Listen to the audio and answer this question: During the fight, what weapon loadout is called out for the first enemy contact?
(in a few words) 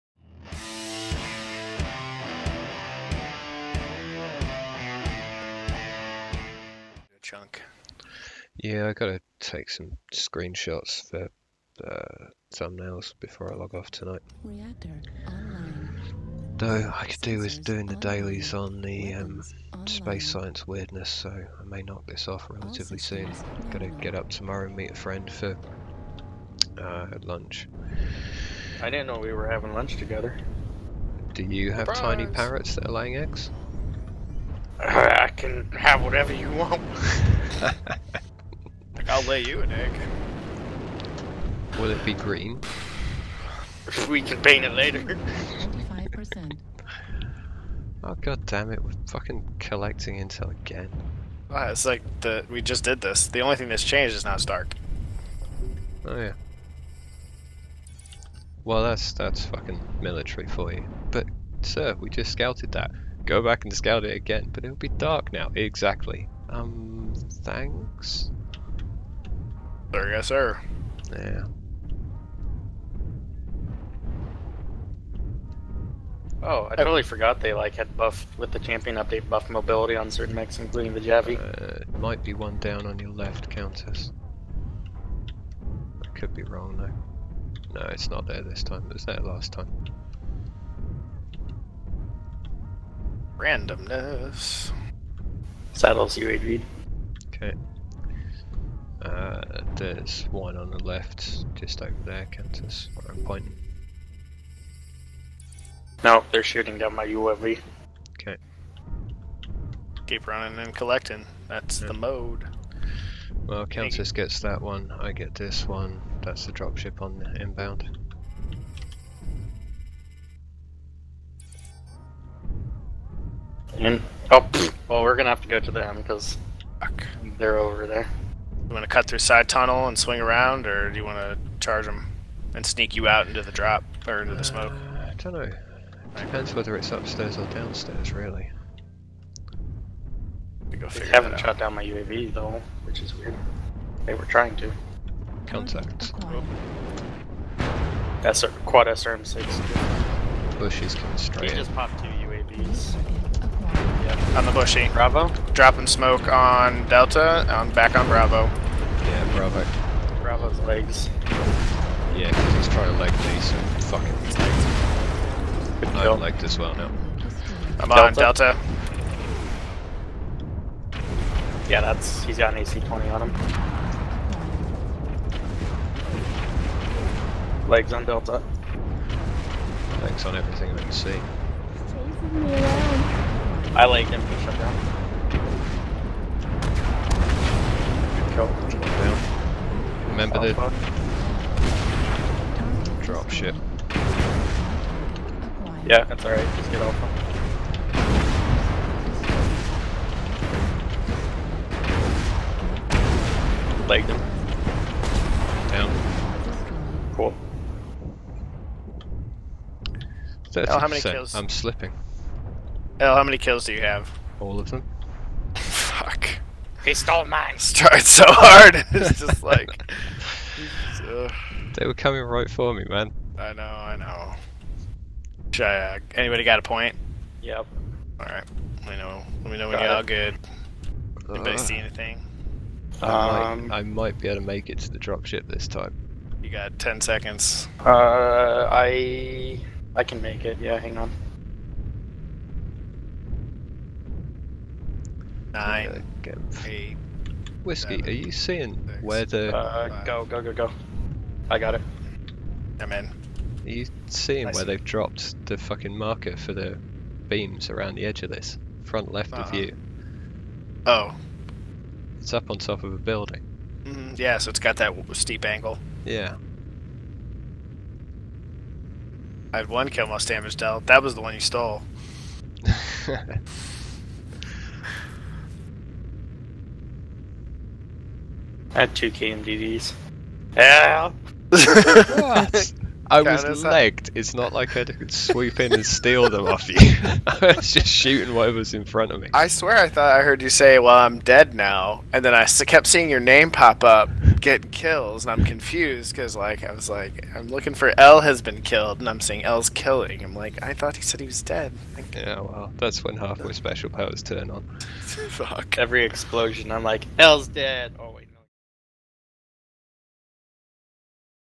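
Quad SRM6.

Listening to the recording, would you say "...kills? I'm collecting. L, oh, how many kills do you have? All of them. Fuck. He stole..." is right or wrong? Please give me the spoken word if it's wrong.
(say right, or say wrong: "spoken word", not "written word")
wrong: "slipping", not "collecting".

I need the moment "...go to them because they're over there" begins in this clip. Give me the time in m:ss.
2:05.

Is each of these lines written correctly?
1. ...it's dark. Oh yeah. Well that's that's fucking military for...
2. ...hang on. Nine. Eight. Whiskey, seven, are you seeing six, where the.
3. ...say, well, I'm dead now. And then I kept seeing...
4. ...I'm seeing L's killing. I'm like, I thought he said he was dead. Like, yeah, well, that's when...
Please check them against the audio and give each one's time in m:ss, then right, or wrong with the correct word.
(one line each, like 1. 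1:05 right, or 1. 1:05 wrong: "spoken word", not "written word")
1. 0:54 right
2. 4:00 right
3. 4:50 right
4. 4:59 right.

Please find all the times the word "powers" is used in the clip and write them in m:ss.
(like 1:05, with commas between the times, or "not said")
5:03.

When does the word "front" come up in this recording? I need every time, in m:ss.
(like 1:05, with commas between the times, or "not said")
4:18, 4:48.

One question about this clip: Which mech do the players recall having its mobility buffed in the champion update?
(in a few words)
Javi.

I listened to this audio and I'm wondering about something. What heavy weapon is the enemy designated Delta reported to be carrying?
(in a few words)
AC-20.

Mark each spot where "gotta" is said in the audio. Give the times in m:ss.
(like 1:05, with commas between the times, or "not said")
0:08, 0:23.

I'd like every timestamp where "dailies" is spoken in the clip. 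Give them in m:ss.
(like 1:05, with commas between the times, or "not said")
0:17.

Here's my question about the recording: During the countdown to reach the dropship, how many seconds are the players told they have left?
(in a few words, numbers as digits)
10.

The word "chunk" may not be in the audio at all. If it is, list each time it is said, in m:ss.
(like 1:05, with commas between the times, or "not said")
0:07.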